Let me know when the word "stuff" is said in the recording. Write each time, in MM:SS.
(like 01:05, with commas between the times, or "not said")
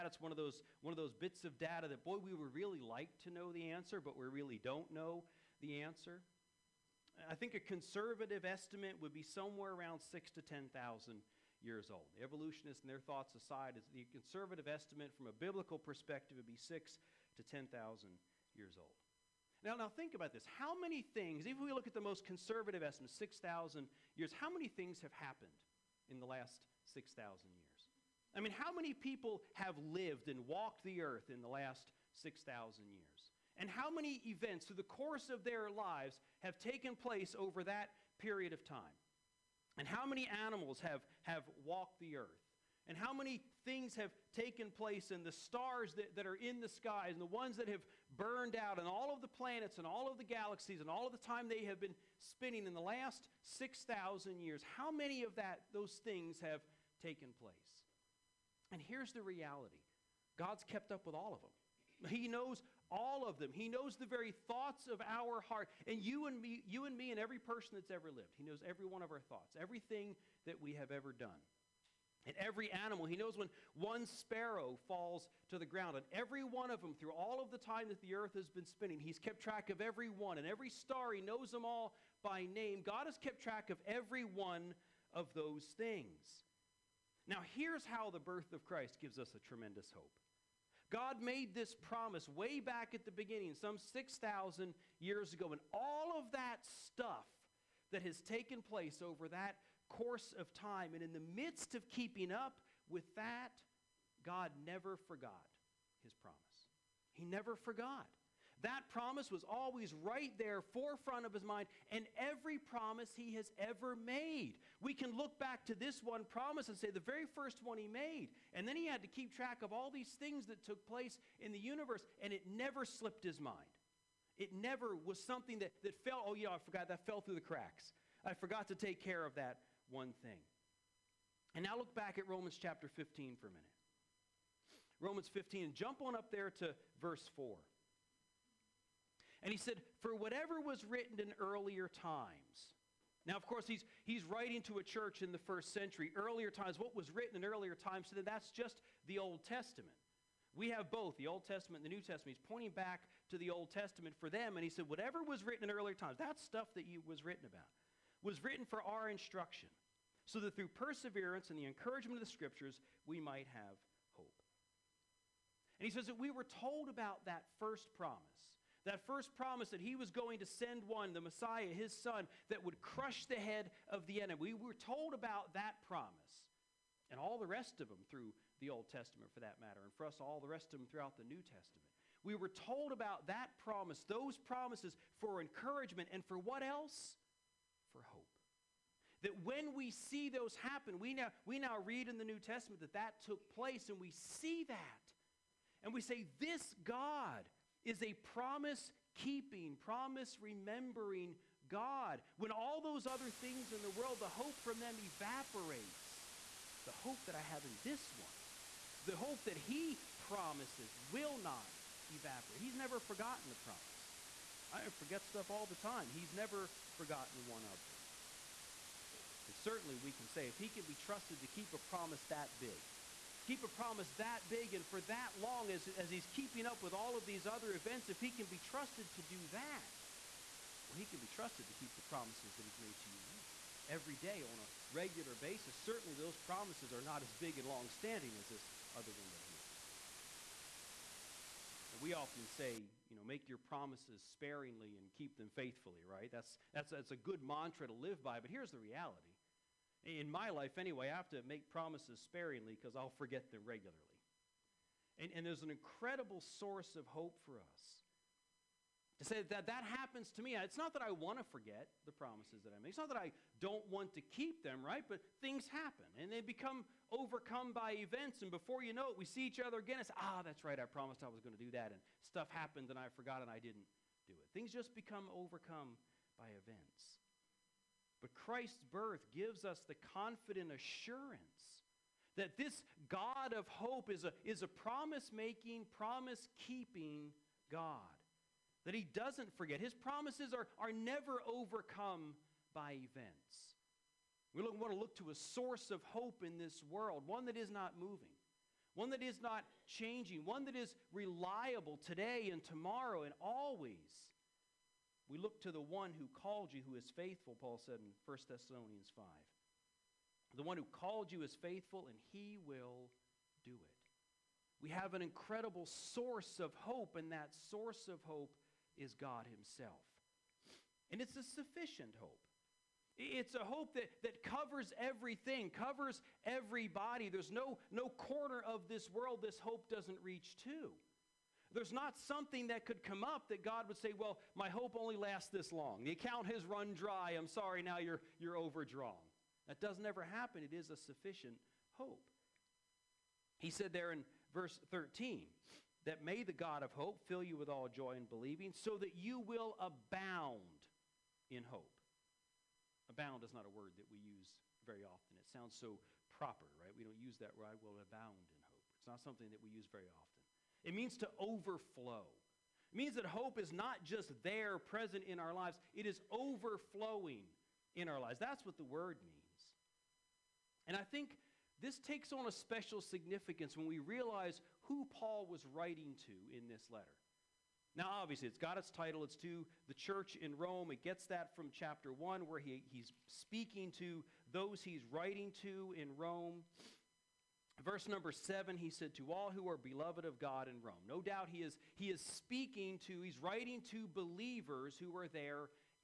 01:36, 02:36, 03:35, 04:32.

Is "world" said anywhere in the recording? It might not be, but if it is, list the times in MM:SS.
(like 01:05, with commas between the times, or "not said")
03:23, 04:56, 05:29.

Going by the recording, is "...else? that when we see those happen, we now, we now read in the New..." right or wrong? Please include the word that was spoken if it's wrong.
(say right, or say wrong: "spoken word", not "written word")
right.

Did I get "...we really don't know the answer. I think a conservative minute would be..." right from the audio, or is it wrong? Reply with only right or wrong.
wrong.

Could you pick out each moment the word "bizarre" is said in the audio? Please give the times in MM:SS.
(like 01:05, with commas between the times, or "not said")
not said.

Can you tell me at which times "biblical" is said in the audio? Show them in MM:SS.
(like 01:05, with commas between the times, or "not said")
00:15.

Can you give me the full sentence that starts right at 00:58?
And here's the reality God's kept up with all of them.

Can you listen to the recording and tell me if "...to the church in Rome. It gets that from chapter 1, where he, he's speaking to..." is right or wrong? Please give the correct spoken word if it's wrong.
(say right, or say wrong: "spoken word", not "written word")
right.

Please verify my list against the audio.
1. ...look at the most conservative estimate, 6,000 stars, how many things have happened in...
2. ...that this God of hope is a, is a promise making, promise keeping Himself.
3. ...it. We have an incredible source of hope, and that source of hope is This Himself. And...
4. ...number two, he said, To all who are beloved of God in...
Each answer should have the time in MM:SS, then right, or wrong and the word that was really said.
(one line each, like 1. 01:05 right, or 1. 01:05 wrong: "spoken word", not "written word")
1. 00:21 wrong: "years", not "stars"
2. 04:42 wrong: "God", not "Himself"
3. 05:13 wrong: "God", not "This"
4. 06:28 wrong: "seven", not "two".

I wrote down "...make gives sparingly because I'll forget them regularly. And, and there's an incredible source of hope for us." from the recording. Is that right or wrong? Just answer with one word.
wrong.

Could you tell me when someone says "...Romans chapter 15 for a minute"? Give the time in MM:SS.
02:12.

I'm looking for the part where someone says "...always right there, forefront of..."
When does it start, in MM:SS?
01:49.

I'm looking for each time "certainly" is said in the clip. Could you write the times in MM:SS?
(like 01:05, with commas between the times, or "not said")
03:39, 03:55.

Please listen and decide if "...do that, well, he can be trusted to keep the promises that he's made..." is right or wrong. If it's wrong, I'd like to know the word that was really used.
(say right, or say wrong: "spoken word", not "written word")
right.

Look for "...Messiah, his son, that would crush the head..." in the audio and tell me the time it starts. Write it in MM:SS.
02:51.